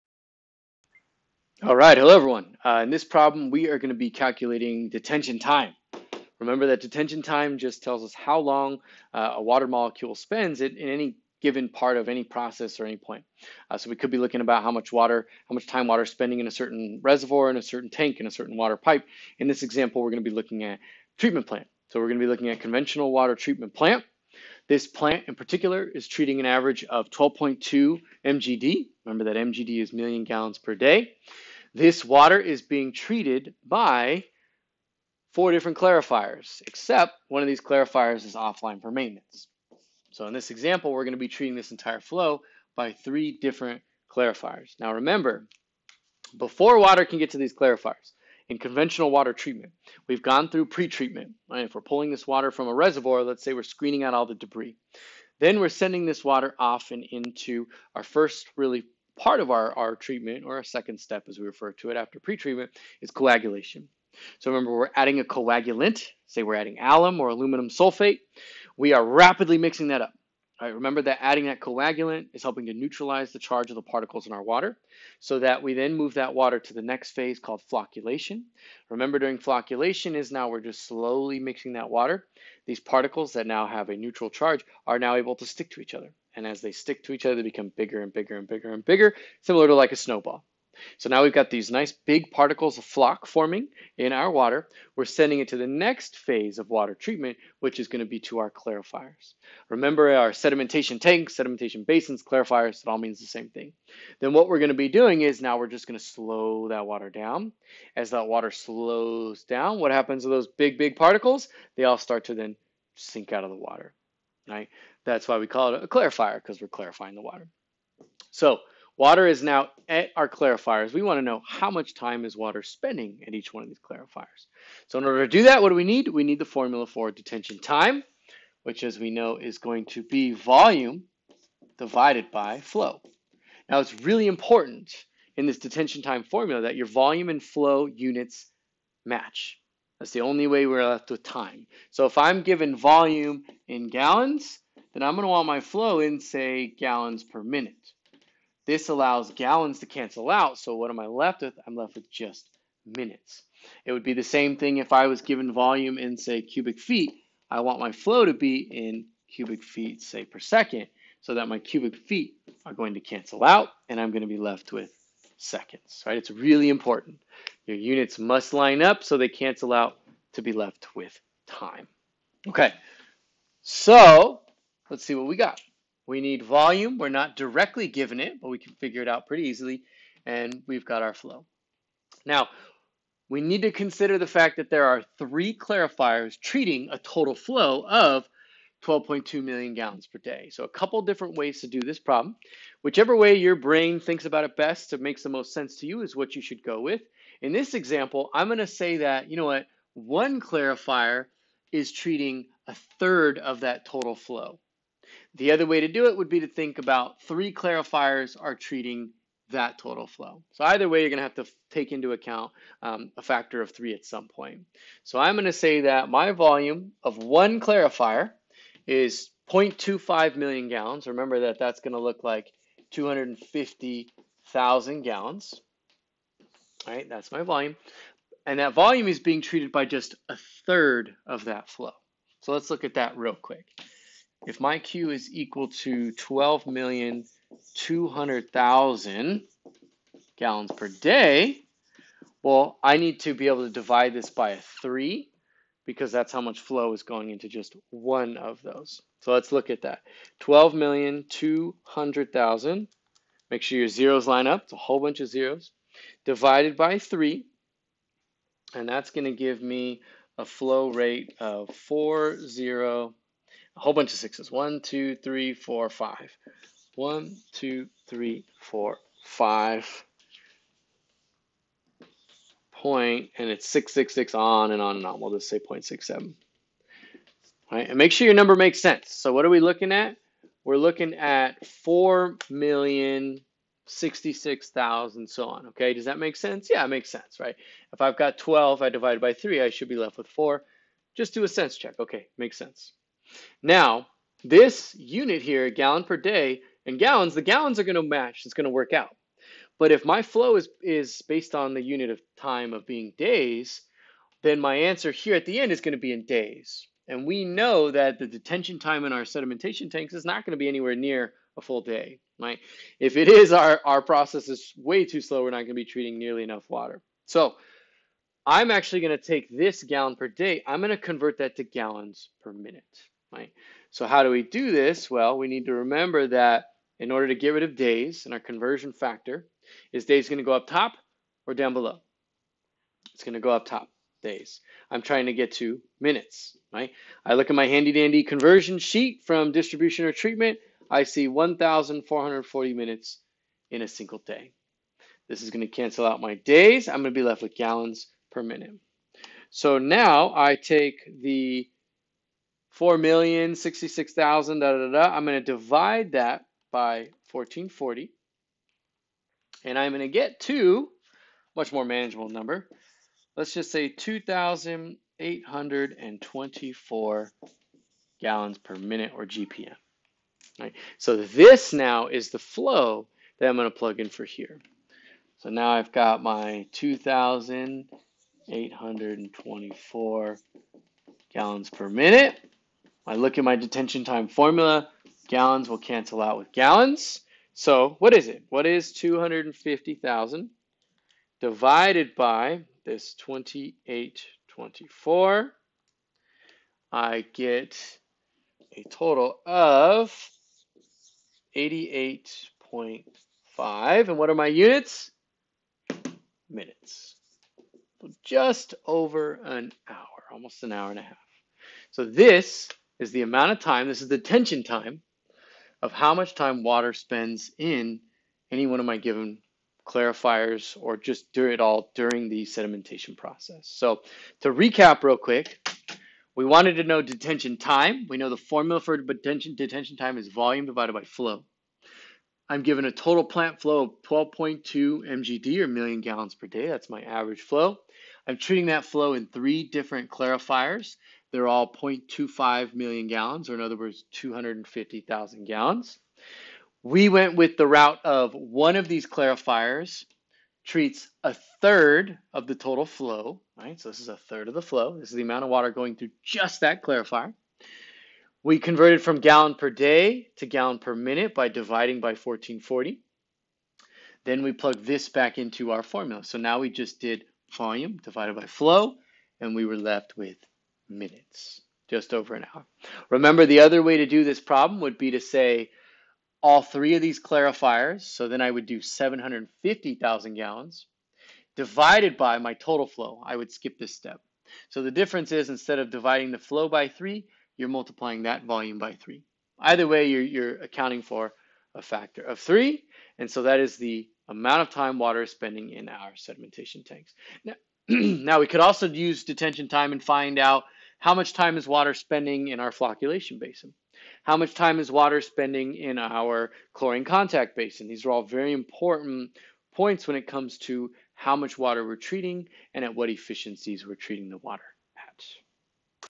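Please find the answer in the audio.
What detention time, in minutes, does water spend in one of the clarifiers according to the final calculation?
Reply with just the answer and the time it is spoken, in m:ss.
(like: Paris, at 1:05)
88.5 minutes, at 6:41.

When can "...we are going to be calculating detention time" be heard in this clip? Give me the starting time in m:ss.
0:03.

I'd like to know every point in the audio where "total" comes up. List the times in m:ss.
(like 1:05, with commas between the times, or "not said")
3:06, 3:23, 3:29, 6:38, 7:12, 7:32, 8:02.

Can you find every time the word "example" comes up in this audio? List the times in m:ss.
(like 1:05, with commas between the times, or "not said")
0:19, 0:40, 3:17.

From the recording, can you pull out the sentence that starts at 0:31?
This water is being treated by four different clarifiers, except one of these clarifiers is offline for maintenance.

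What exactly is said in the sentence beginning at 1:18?
Remember during flocculation is now we're just slowly mixing that water.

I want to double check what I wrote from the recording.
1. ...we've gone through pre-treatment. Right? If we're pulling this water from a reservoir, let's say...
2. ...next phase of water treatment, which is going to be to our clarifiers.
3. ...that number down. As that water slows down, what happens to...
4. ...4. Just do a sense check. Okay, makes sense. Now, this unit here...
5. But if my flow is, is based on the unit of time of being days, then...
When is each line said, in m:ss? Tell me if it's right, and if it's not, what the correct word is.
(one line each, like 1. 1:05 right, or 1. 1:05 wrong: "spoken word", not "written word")
1. 0:50 right
2. 1:35 right
3. 1:46 wrong: "water", not "number"
4. 4:50 right
5. 4:59 right.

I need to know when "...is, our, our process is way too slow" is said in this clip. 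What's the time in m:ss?
5:13.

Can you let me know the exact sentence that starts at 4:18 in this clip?
And that's going to give me a flow rate of 4, 0, a whole bunch of sixes.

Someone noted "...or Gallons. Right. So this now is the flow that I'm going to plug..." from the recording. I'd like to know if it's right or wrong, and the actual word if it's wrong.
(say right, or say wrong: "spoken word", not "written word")
wrong: "GPM", not "Gallons".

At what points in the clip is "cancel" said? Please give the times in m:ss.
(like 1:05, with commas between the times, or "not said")
2:29, 2:43, 2:49, 5:45, 6:25.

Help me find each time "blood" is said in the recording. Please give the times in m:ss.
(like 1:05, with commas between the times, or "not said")
not said.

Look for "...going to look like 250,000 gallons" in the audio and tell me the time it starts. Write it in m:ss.
3:41.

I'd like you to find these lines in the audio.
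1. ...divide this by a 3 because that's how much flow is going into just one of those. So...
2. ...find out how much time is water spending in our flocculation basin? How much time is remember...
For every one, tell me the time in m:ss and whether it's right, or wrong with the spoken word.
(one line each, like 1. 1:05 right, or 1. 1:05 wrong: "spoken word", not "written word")
1. 4:03 right
2. 8:20 wrong: "water", not "remember".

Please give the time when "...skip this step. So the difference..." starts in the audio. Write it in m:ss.
8:03.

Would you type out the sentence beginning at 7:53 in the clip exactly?
Remember, the other way to do this problem would be to say all three of these clarifiers.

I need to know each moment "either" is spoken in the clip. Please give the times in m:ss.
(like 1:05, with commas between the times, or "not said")
3:30, 8:09.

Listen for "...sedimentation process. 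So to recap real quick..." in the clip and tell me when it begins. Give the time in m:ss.
7:02.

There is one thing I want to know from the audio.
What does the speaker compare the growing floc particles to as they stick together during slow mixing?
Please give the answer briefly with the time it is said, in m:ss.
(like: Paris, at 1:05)
a snowball, at 1:29.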